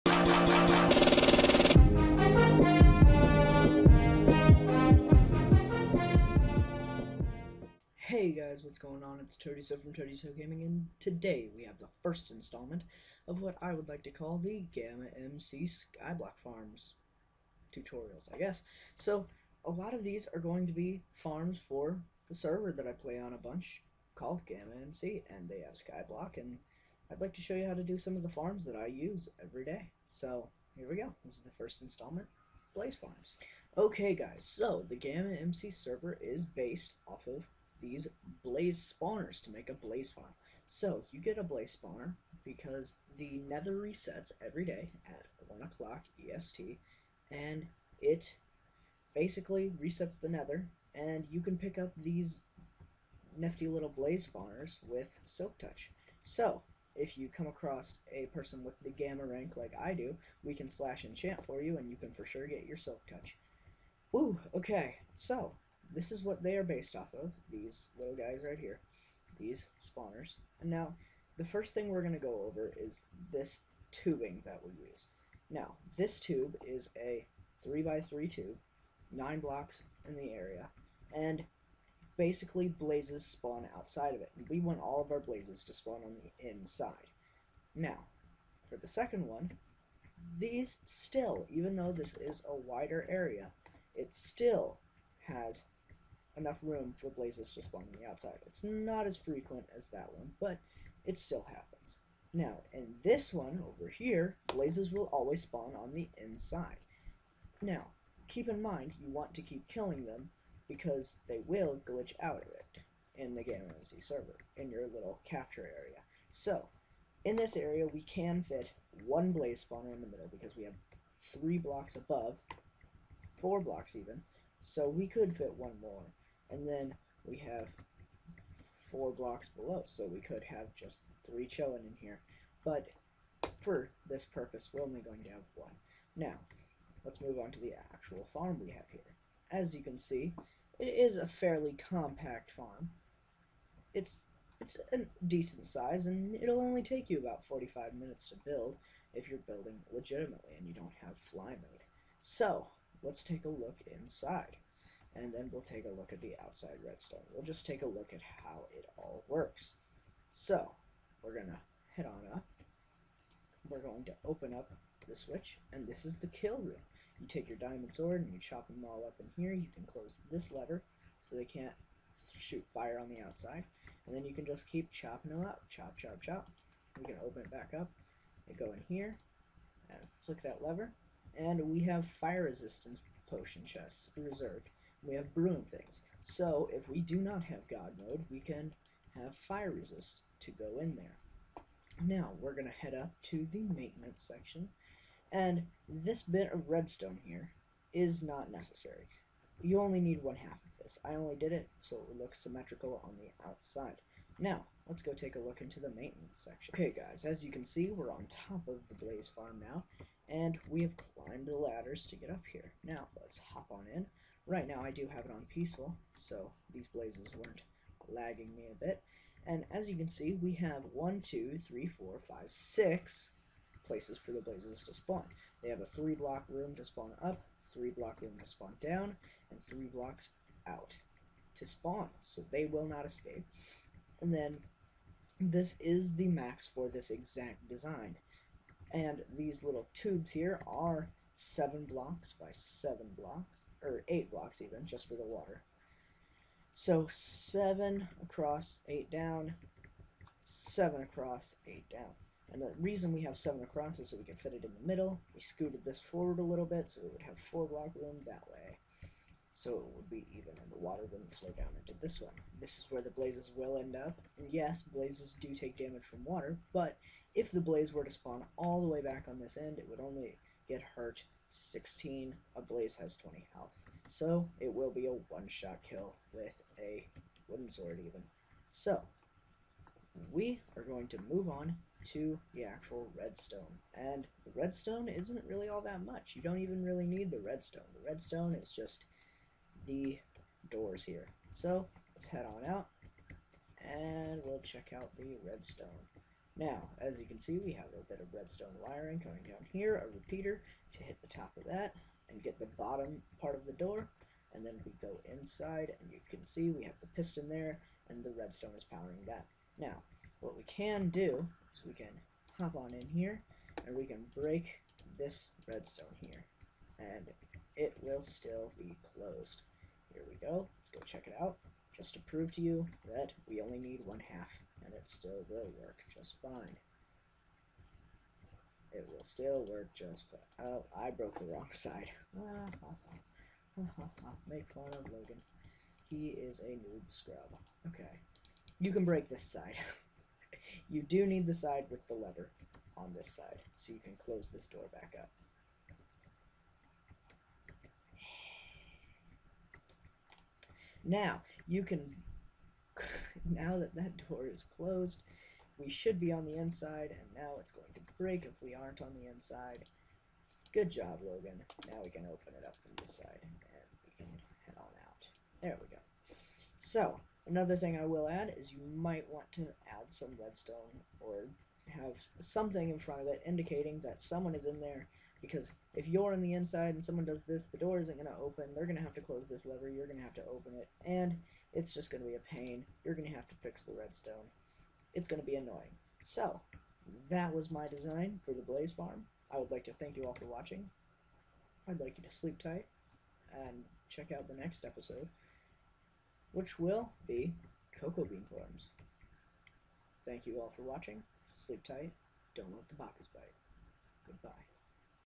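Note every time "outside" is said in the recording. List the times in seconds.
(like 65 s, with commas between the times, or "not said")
83 s, 98 s, 156 s, 173 s, 203 s.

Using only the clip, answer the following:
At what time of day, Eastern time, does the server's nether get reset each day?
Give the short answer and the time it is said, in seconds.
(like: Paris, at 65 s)
1 o'clock, at 45 s.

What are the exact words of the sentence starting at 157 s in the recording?
We'll just take a look at how it all works.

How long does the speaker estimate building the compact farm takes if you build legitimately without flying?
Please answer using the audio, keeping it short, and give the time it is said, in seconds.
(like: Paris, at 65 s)
45 minutes, at 147 s.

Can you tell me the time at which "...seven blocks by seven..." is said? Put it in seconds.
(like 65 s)
241 s.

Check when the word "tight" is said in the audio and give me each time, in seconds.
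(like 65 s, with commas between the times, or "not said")
392 s, 401 s.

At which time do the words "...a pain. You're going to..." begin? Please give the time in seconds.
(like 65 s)
382 s.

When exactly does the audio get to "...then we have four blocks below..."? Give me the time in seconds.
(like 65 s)
126 s.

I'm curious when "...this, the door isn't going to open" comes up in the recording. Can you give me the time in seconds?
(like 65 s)
377 s.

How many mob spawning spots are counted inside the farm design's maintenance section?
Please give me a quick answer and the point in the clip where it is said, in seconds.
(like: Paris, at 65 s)
6, at 222 s.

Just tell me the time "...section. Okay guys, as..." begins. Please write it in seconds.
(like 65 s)
206 s.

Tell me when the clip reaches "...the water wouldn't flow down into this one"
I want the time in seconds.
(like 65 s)
260 s.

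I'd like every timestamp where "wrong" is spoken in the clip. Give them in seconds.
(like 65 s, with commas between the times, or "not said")
331 s.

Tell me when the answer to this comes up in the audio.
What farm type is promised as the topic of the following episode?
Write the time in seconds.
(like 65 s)
397 s.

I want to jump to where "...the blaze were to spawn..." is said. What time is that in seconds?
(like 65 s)
267 s.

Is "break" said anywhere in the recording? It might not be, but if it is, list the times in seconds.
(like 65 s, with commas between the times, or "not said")
314 s, 339 s, 358 s.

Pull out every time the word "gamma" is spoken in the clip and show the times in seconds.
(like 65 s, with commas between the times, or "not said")
14 s, 24 s, 34 s, 58 s, 113 s.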